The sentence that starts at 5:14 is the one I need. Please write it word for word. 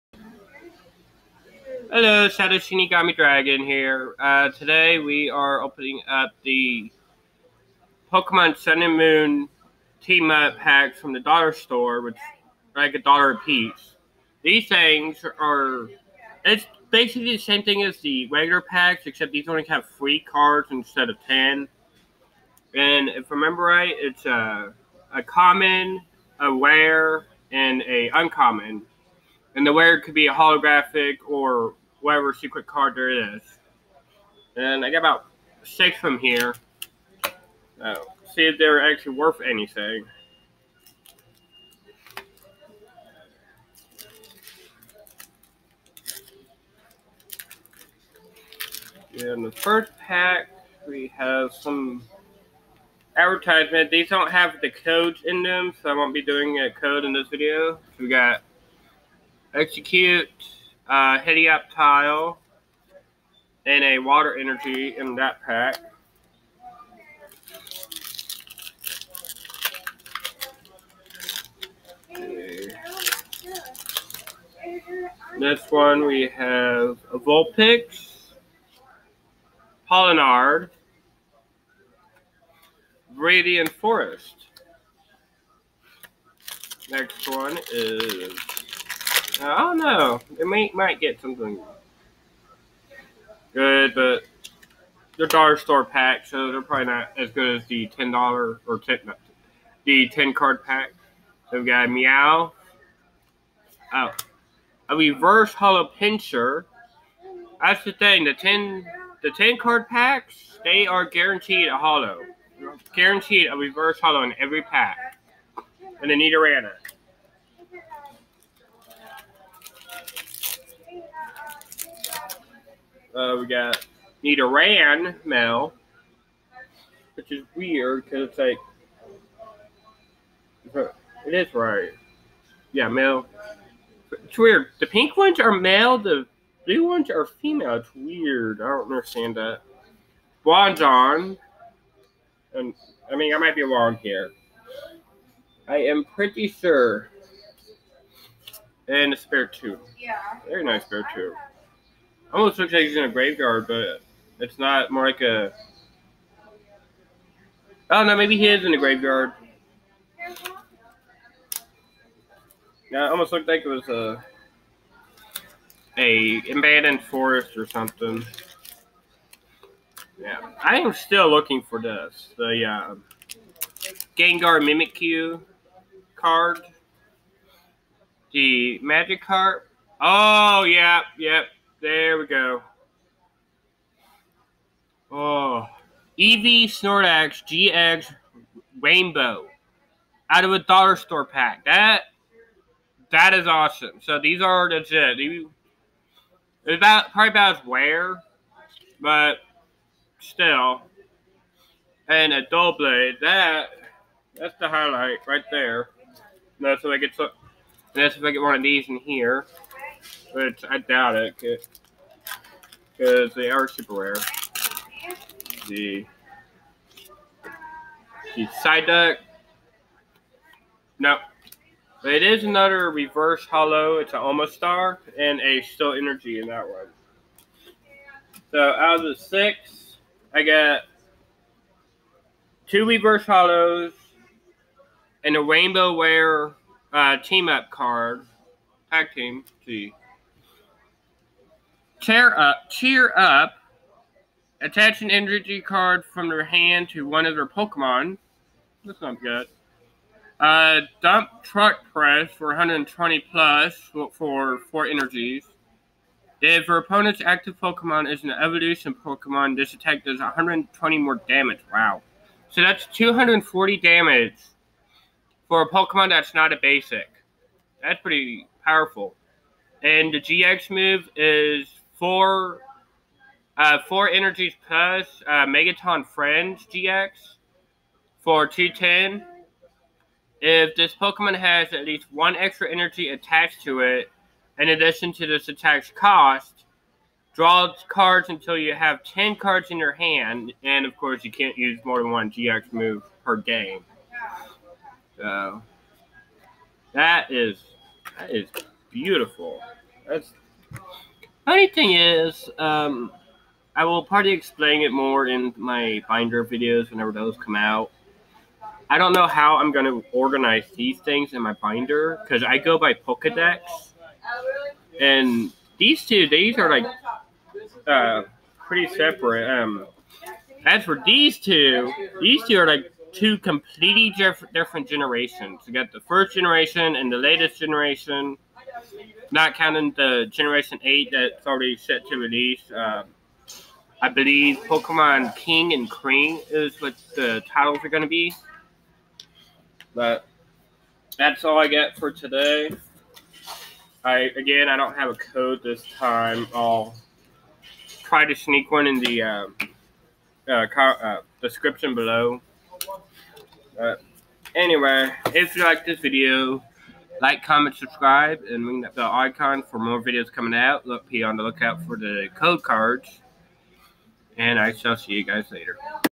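And these two, these are like uh, pretty separate.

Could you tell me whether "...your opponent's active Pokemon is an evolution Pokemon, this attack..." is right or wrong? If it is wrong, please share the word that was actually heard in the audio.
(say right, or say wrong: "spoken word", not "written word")
right.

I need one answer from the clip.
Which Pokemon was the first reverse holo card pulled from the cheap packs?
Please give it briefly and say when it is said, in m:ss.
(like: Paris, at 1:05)
Pinsir, at 1:45.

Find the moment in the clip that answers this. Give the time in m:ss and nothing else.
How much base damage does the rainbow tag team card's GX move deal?
4:38.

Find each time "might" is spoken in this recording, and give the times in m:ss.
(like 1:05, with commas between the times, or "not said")
1:30, 2:23.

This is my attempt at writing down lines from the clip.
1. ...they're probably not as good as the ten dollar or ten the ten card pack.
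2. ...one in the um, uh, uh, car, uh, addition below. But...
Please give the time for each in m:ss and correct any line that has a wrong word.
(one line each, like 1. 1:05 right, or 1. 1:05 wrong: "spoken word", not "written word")
1. 1:36 right
2. 5:48 wrong: "description", not "addition".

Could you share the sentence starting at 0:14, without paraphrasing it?
These things are it's basically the same thing as the regular packs, except these only have three cards instead of ten.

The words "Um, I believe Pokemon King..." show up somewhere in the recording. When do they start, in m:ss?
5:32.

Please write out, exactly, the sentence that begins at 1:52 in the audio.
Guaranteed a reverse holo in every pack.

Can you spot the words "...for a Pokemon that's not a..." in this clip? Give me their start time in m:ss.
4:25.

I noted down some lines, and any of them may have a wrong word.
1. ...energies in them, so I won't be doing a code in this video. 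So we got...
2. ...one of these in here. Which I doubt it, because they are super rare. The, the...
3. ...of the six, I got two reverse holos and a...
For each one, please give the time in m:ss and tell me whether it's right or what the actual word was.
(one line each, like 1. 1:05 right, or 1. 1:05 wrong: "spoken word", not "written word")
1. 0:54 wrong: "codes", not "energies"
2. 3:28 right
3. 3:48 right.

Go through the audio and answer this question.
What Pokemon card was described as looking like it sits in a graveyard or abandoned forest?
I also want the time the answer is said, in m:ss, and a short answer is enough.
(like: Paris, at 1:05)
Spiritomb, at 2:29.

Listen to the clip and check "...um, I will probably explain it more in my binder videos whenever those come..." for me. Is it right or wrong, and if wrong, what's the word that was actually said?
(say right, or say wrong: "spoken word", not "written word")
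right.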